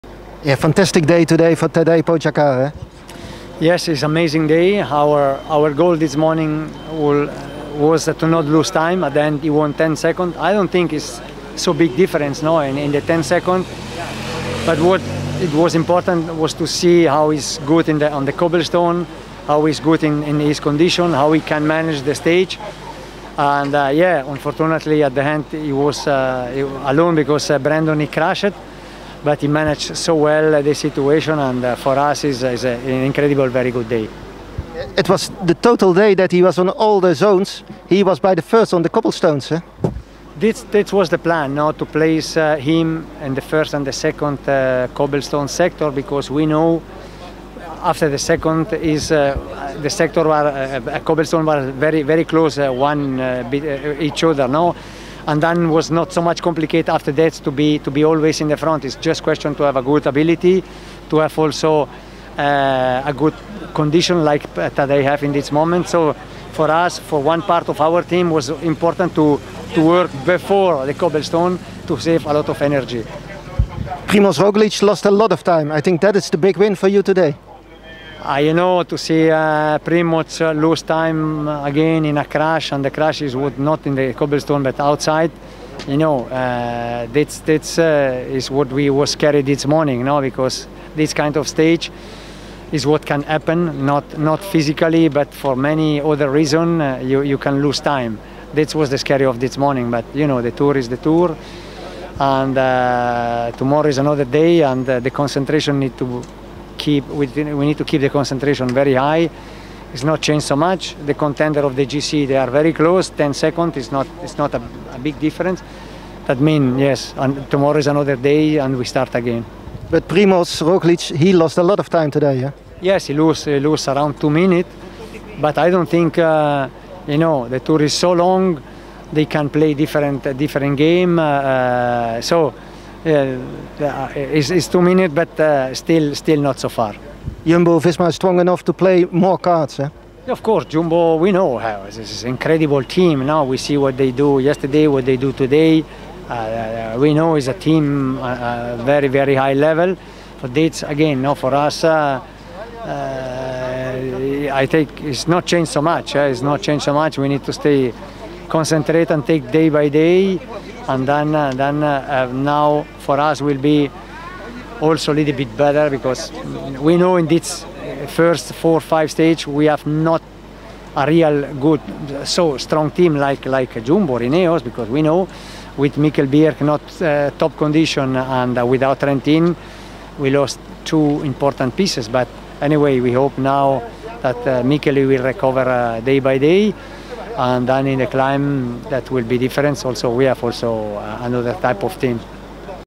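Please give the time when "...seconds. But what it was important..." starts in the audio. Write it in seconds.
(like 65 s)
13 s.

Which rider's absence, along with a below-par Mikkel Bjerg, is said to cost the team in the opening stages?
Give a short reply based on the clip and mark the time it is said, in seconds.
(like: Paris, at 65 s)
Trentin, at 178 s.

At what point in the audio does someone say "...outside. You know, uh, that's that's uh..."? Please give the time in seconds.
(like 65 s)
84 s.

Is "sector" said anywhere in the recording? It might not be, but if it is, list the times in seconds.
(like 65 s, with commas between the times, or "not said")
45 s, 49 s.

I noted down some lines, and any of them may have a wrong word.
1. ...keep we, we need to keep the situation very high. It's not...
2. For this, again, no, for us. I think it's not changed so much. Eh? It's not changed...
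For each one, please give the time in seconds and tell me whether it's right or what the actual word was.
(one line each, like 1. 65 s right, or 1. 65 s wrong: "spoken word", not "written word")
1. 106 s wrong: "concentration", not "situation"
2. 150 s right.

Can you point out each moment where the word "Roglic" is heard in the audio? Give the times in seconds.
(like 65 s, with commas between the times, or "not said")
74 s, 120 s.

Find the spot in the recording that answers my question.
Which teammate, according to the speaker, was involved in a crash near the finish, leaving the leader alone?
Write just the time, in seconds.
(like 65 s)
27 s.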